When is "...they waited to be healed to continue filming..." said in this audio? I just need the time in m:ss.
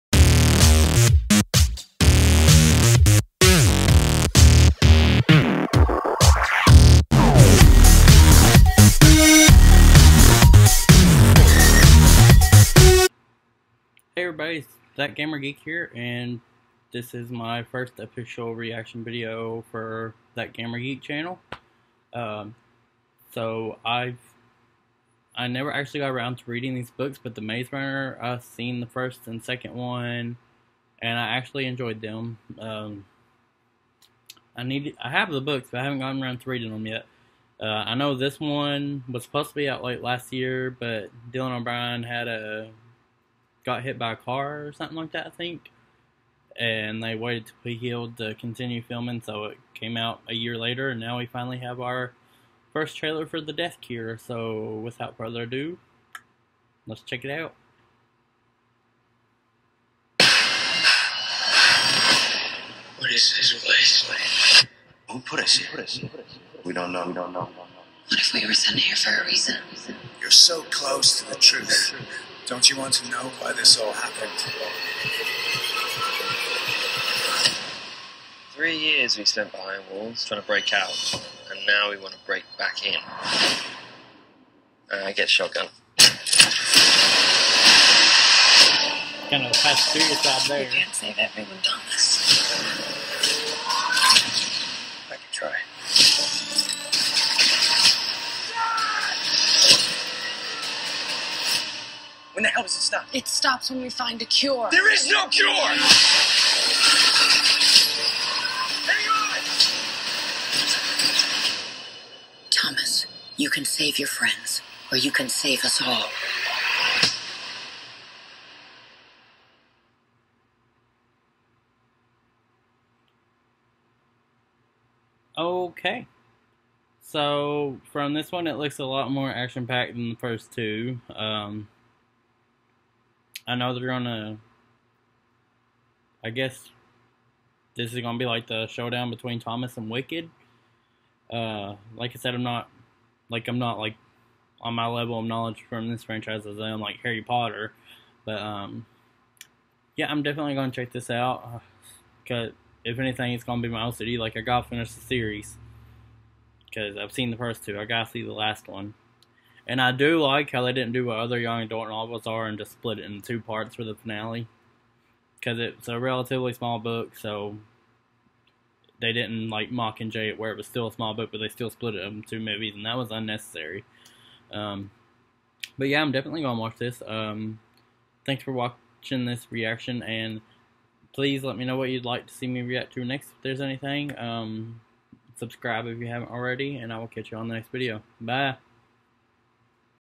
0:47.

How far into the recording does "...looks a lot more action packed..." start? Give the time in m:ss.
2:08.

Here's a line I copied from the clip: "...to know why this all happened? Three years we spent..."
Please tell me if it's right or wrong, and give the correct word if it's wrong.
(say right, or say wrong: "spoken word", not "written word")
right.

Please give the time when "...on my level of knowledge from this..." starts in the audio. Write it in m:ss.
2:24.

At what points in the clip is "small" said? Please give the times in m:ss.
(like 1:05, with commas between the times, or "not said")
2:46, 2:50.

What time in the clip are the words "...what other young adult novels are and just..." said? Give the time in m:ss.
2:41.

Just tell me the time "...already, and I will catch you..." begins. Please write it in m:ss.
3:06.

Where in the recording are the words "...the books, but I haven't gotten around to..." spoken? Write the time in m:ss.
0:35.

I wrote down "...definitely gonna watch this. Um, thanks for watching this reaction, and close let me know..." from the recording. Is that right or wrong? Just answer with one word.
wrong.